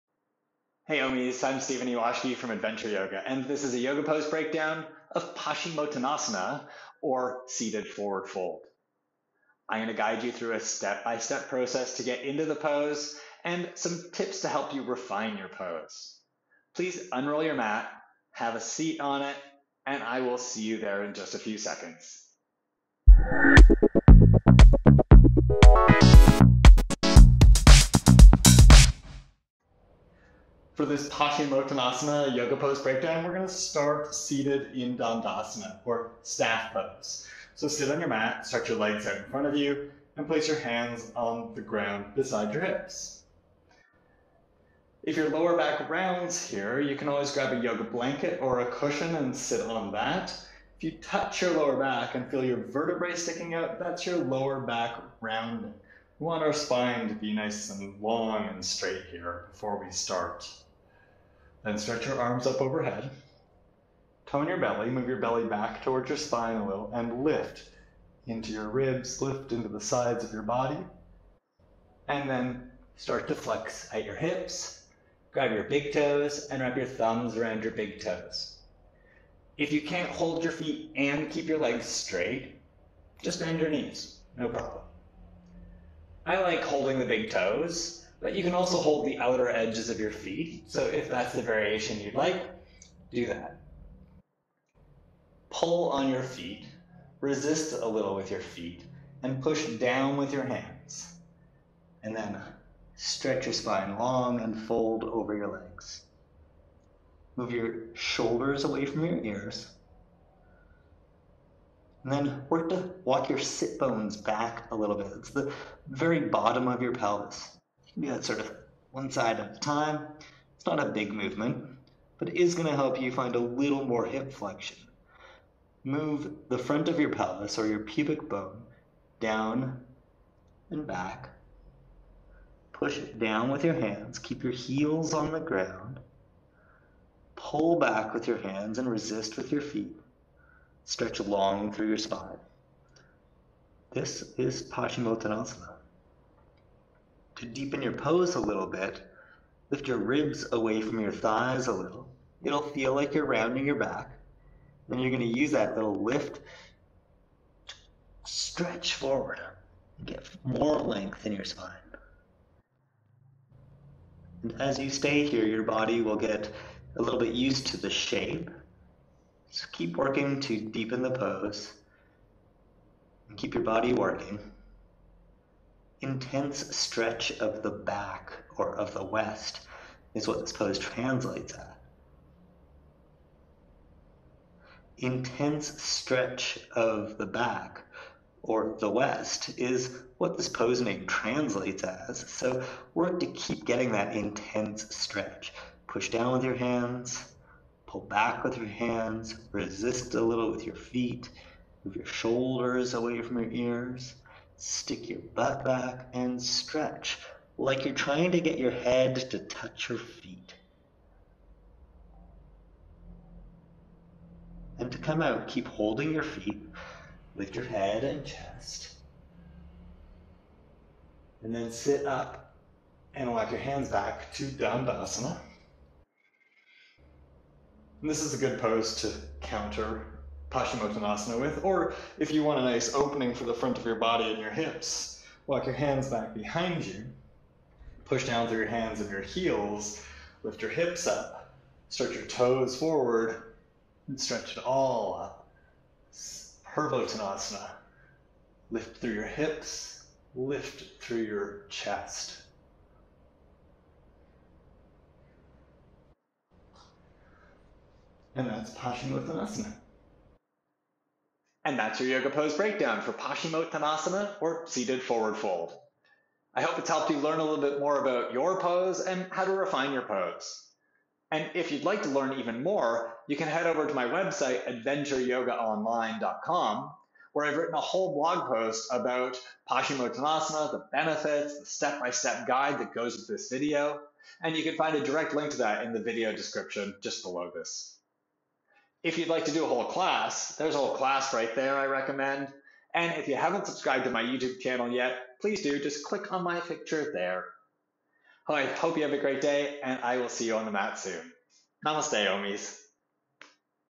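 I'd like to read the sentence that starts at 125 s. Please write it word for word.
Move the front of your pelvis or your pubic bone down and back.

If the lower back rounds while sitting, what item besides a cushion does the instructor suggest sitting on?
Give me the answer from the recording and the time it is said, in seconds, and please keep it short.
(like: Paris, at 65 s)
yoga blanket, at 47 s.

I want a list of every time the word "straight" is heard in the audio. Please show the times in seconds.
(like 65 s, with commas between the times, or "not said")
58 s, 81 s.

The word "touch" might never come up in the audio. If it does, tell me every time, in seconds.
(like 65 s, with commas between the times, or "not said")
50 s, 209 s.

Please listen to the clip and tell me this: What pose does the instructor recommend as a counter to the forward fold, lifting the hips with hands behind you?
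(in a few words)
Purvottanasana.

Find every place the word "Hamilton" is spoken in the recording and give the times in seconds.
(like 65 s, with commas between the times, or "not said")
not said.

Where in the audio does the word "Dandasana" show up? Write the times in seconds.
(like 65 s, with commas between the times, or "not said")
34 s, 224 s.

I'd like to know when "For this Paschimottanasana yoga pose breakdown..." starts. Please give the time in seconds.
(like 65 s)
30 s.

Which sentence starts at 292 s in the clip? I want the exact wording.
And if you haven't subscribed to my YouTube channel yet, please do.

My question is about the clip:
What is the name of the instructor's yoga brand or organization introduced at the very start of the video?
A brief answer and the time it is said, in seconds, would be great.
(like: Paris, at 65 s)
Adventure Yoga, at 2 s.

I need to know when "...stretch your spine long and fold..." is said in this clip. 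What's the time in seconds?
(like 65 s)
102 s.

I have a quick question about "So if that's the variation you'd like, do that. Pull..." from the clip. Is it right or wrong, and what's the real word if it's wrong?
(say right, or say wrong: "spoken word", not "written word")
right.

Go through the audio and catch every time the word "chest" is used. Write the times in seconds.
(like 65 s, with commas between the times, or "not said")
218 s, 251 s.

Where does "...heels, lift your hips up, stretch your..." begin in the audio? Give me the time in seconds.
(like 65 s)
239 s.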